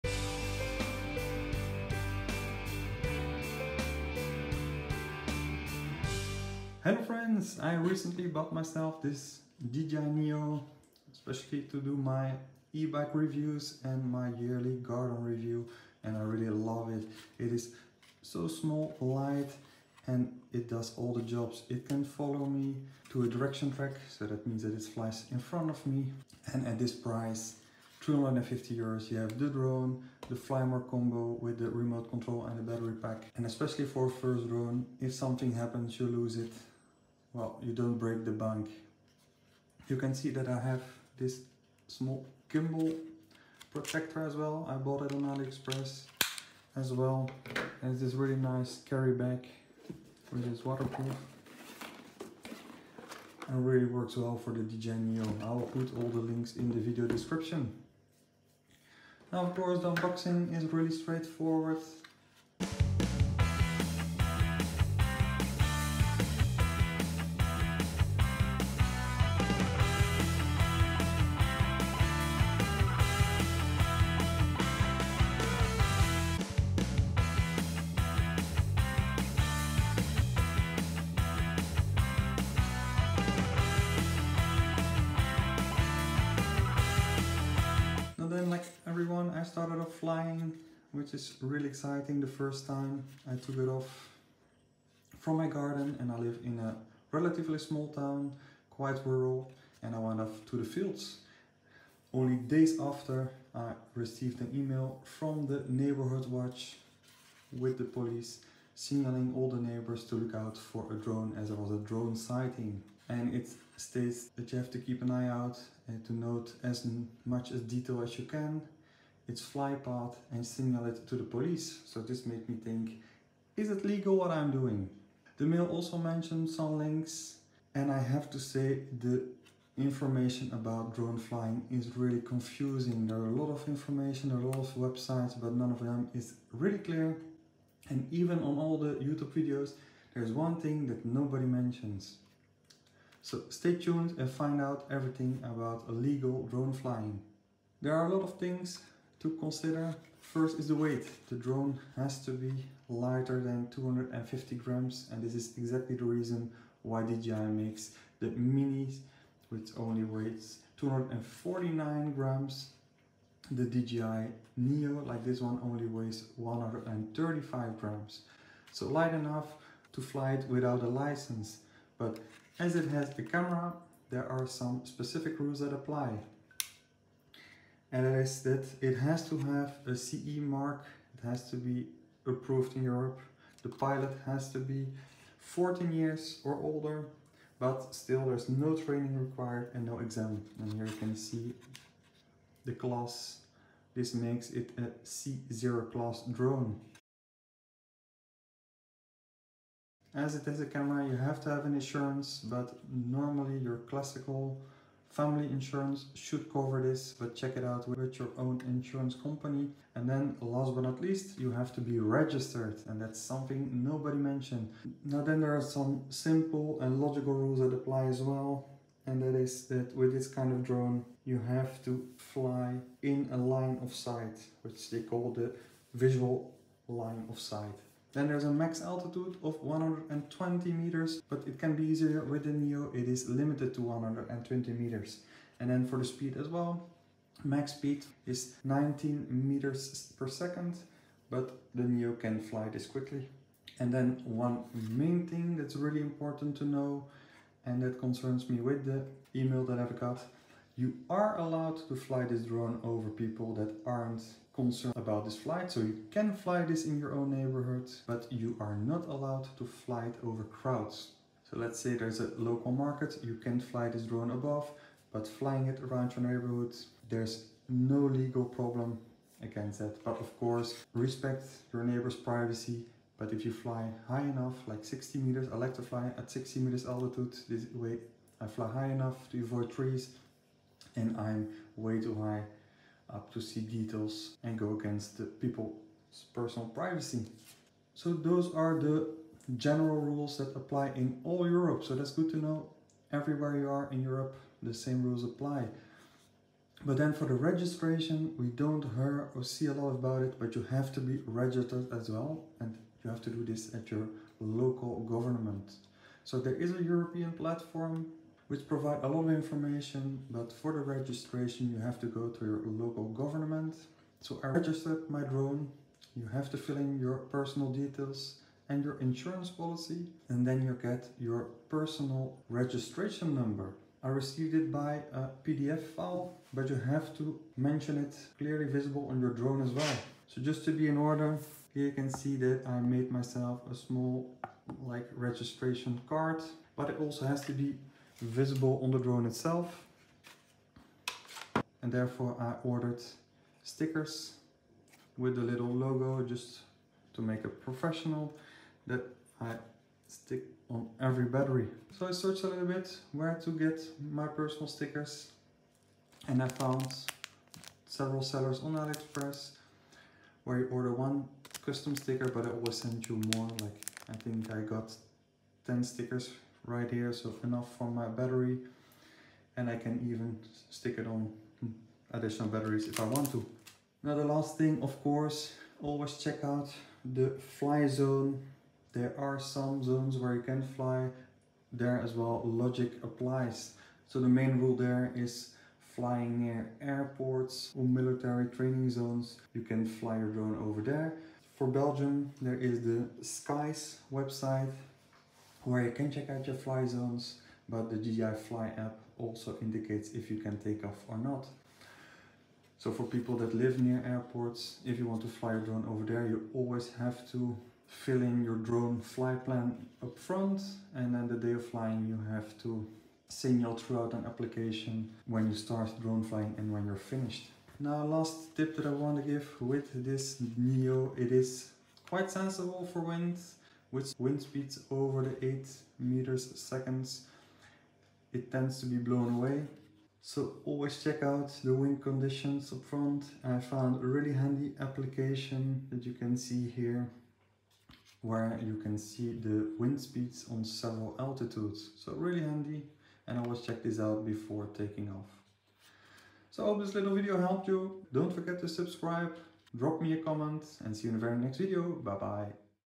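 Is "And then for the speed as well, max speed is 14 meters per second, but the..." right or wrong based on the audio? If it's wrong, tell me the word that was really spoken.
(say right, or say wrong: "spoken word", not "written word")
wrong: "19", not "14".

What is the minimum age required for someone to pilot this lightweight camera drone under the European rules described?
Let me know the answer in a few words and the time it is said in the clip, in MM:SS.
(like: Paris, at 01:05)
14, at 03:05.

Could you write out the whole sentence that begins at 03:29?
And then last but not least, you have to be registered and that's something nobody mentioned.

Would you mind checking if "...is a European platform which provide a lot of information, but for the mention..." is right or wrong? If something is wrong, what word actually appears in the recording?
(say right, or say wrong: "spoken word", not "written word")
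wrong: "registration", not "mention".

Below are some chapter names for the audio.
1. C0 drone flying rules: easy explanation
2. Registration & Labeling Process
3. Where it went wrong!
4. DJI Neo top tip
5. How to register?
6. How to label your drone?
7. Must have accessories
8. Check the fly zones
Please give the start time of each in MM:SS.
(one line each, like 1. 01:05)
1. 02:28
2. 01:00
3. 01:28
4. 06:58
5. 05:00
6. 05:40
7. 00:41
8. 06:14.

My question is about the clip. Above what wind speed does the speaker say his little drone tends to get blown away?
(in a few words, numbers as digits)
8 meters per second.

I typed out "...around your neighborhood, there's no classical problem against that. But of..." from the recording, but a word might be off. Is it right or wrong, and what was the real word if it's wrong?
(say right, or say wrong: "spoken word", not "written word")
wrong: "legal", not "classical".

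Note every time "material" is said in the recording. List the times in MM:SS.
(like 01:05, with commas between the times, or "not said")
not said.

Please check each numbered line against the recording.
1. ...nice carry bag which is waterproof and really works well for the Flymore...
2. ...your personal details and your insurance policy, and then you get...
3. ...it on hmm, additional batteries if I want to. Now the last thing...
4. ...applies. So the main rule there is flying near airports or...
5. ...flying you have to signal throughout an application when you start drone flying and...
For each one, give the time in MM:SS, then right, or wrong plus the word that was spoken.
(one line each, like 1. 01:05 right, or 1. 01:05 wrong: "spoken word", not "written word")
1. 00:48 wrong: "DJI", not "Flymore"
2. 05:16 right
3. 06:10 right
4. 06:23 right
5. 06:51 right.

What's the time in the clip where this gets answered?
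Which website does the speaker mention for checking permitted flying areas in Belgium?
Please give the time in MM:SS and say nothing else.
06:33.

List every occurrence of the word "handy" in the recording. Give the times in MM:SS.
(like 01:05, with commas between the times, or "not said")
07:14, 07:22.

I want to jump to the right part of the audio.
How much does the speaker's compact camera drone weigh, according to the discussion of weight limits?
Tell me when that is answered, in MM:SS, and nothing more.
02:46.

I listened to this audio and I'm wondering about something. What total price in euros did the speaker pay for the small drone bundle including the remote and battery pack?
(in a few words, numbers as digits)
250 euros.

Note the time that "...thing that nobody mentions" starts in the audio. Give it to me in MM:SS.
02:20.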